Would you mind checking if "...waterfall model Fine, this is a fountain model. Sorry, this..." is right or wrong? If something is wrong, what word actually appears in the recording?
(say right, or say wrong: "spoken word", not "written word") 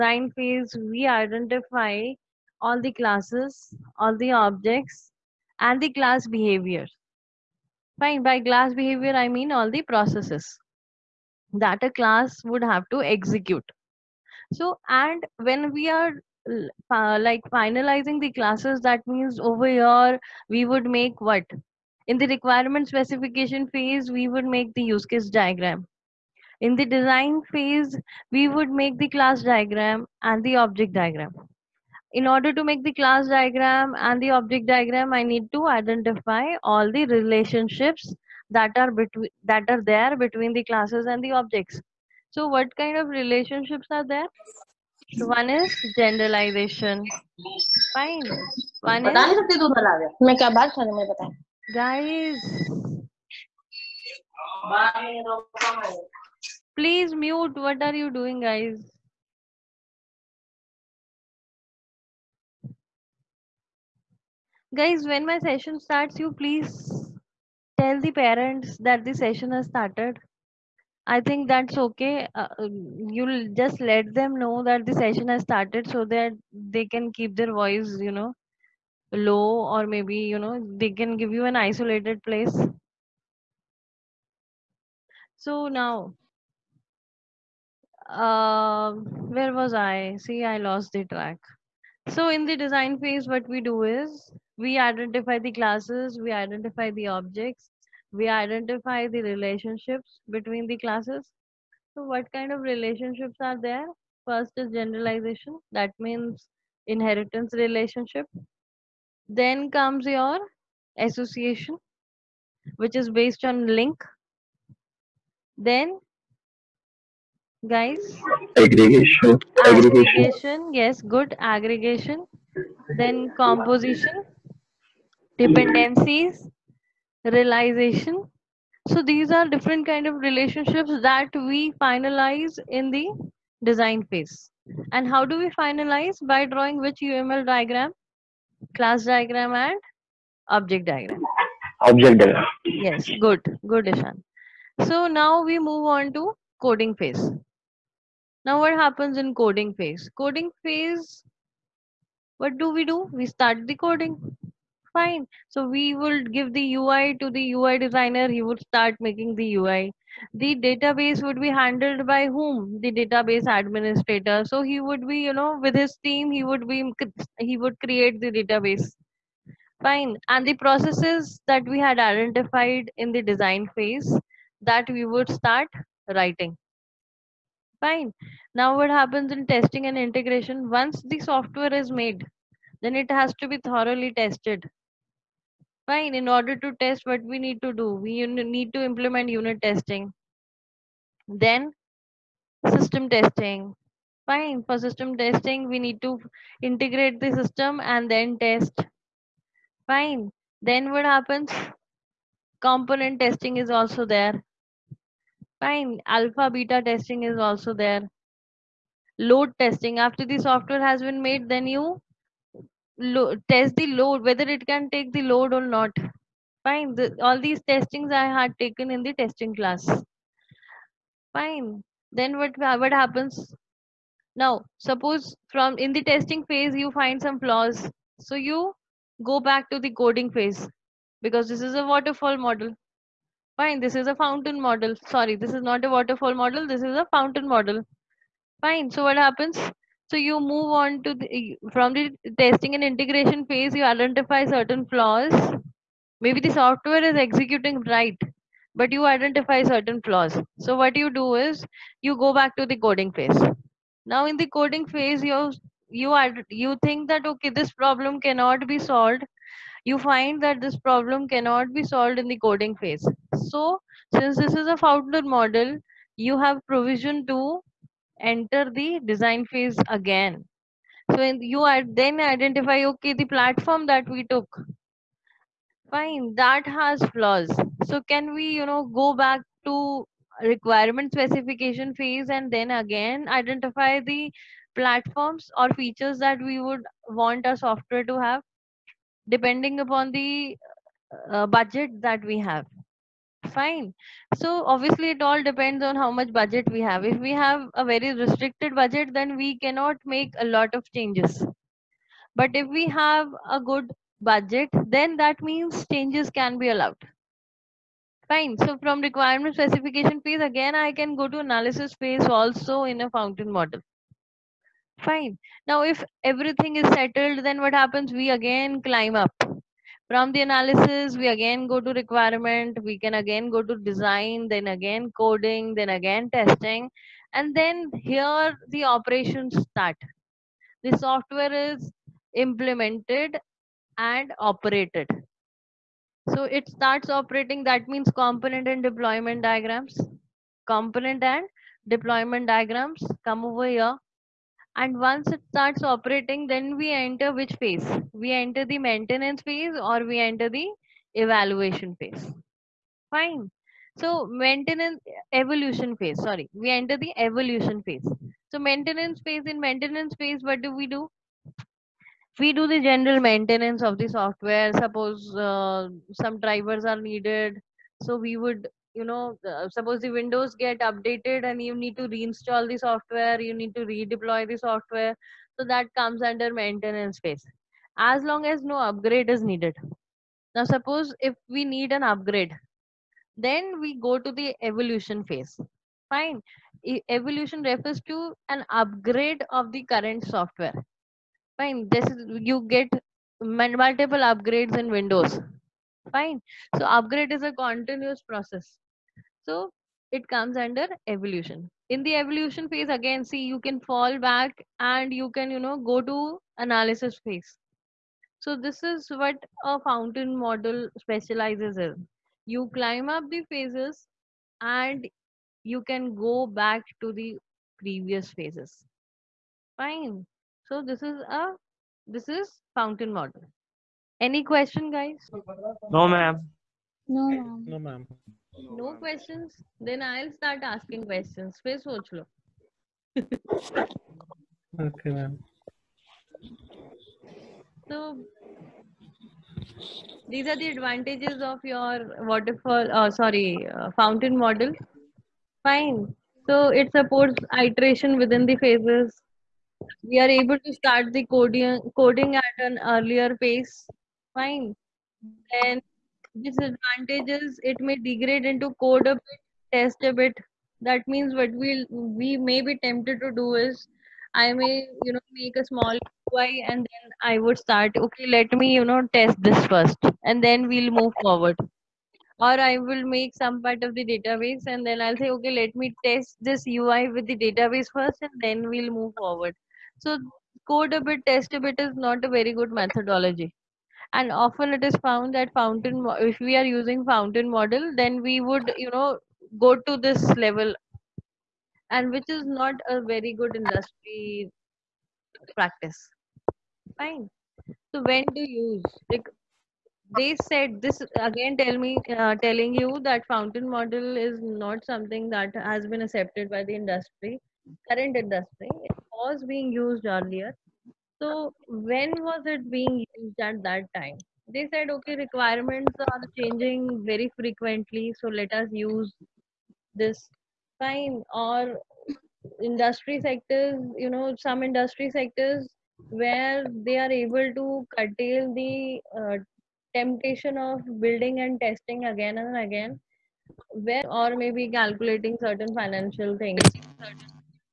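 right.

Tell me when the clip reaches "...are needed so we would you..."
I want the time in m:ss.
6:06.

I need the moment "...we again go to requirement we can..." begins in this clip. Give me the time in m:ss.
5:21.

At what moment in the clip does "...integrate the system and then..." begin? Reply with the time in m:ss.
3:16.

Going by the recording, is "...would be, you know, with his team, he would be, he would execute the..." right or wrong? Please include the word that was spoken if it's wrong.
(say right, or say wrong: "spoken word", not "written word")
wrong: "create", not "execute".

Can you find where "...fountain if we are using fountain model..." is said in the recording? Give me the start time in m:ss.
8:05.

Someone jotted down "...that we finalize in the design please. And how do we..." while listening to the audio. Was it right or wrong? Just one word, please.
wrong.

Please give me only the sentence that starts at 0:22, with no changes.
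In the requirement specification phase, we would make the use case diagram.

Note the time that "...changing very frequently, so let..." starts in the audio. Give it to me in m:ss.
8:36.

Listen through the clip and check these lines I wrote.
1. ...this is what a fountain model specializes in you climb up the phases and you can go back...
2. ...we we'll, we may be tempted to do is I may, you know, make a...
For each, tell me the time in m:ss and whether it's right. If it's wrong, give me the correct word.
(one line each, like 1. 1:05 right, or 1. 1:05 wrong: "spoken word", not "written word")
1. 6:48 right
2. 7:41 right.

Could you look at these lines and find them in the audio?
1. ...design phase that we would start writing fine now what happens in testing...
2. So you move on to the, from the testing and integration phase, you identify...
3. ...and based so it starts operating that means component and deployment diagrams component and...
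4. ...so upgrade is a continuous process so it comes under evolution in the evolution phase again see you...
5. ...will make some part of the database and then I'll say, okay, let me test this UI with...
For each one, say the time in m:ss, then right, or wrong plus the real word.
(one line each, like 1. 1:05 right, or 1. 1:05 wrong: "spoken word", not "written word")
1. 2:53 right
2. 4:00 right
3. 5:33 wrong: "operated", not "based"
4. 6:36 right
5. 7:52 right.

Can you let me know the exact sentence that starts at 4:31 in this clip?
So you then identify, okay, the platform that we took, fine, that has flaws.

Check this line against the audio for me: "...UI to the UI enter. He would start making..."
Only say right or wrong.
wrong.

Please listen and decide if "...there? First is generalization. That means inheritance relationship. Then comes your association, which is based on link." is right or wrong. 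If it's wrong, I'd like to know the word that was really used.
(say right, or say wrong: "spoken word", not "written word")
right.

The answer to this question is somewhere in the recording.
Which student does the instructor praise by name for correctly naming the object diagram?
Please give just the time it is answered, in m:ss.
2:23.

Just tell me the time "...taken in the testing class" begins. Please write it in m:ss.
3:38.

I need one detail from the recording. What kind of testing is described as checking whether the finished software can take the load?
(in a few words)
Load testing.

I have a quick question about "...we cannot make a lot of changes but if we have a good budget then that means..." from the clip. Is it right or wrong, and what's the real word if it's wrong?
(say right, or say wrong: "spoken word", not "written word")
right.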